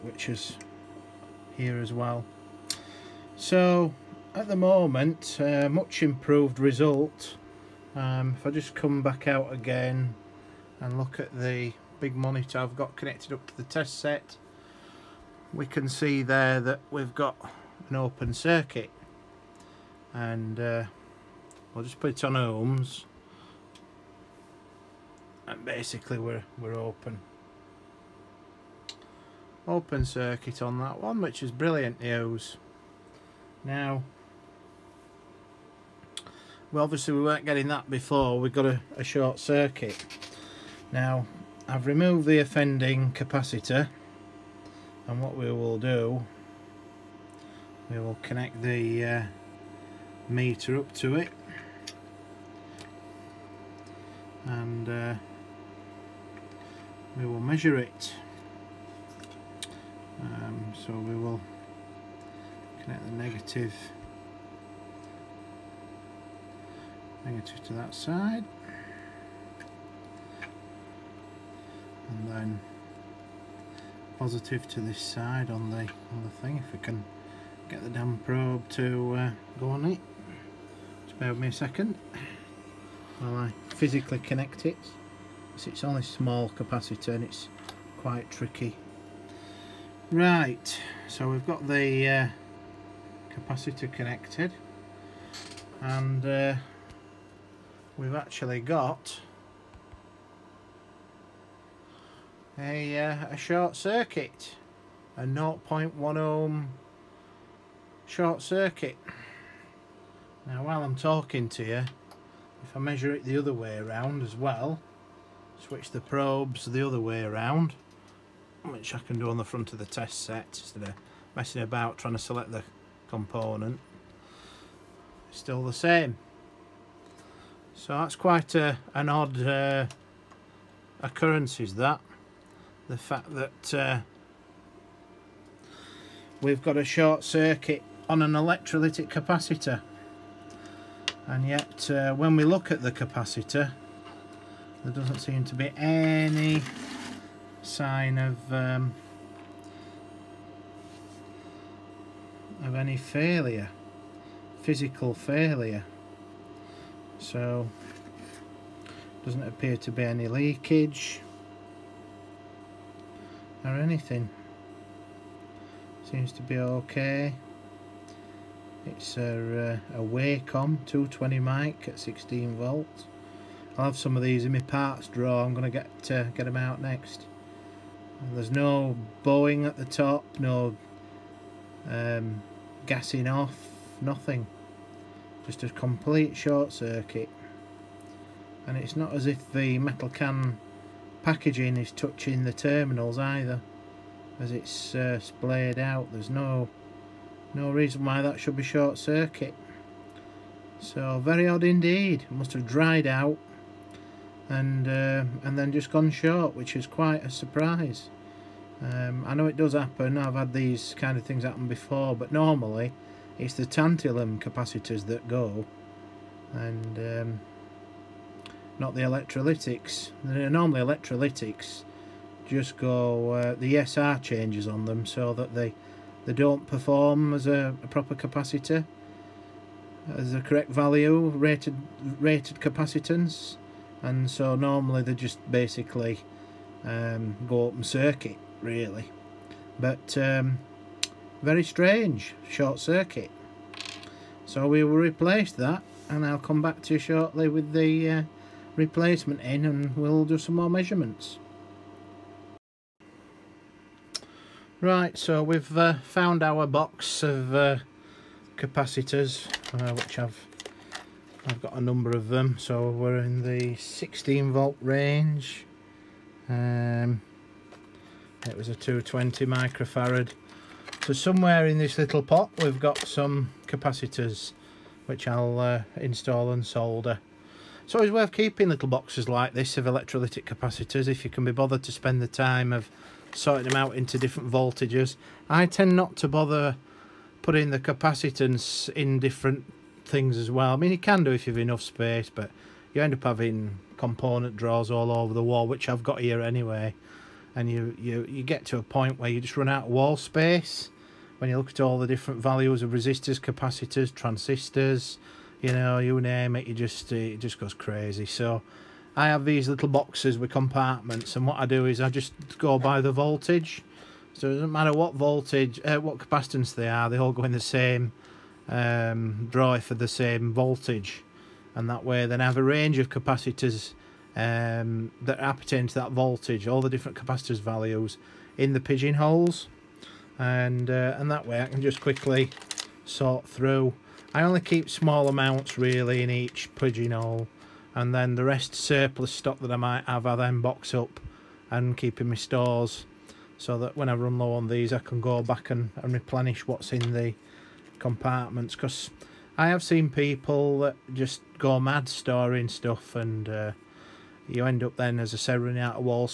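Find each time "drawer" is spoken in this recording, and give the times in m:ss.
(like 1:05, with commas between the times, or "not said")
2:55, 4:54, 5:19.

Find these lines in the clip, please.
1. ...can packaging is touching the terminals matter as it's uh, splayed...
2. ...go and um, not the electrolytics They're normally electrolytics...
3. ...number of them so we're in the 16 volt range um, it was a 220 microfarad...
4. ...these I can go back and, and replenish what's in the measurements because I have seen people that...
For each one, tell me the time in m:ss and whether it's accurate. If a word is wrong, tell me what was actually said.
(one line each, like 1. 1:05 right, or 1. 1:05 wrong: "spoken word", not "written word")
1. 3:10 wrong: "either", not "matter"
2. 3:35 right
3. 4:21 right
4. 5:44 wrong: "compartments", not "measurements".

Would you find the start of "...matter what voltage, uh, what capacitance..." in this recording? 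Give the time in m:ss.
5:14.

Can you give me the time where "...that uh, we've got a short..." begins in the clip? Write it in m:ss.
2:13.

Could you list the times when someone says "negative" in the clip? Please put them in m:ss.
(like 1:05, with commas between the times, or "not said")
1:03, 1:07.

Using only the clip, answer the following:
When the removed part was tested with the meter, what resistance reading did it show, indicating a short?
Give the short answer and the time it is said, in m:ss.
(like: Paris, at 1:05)
0.1 ohm, at 1:45.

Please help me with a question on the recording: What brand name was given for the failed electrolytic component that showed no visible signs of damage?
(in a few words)
Wacom.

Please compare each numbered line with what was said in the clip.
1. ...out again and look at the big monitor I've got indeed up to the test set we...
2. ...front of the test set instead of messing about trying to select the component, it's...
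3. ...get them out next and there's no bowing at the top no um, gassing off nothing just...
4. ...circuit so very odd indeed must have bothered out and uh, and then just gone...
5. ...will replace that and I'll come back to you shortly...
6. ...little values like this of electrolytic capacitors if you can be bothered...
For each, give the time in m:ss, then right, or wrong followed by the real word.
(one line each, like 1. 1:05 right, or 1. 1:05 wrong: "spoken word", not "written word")
1. 0:09 wrong: "connected", not "indeed"
2. 1:59 right
3. 2:56 right
4. 3:18 wrong: "dried", not "bothered"
5. 4:04 right
6. 4:38 wrong: "boxes", not "values".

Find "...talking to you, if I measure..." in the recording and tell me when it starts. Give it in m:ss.
1:50.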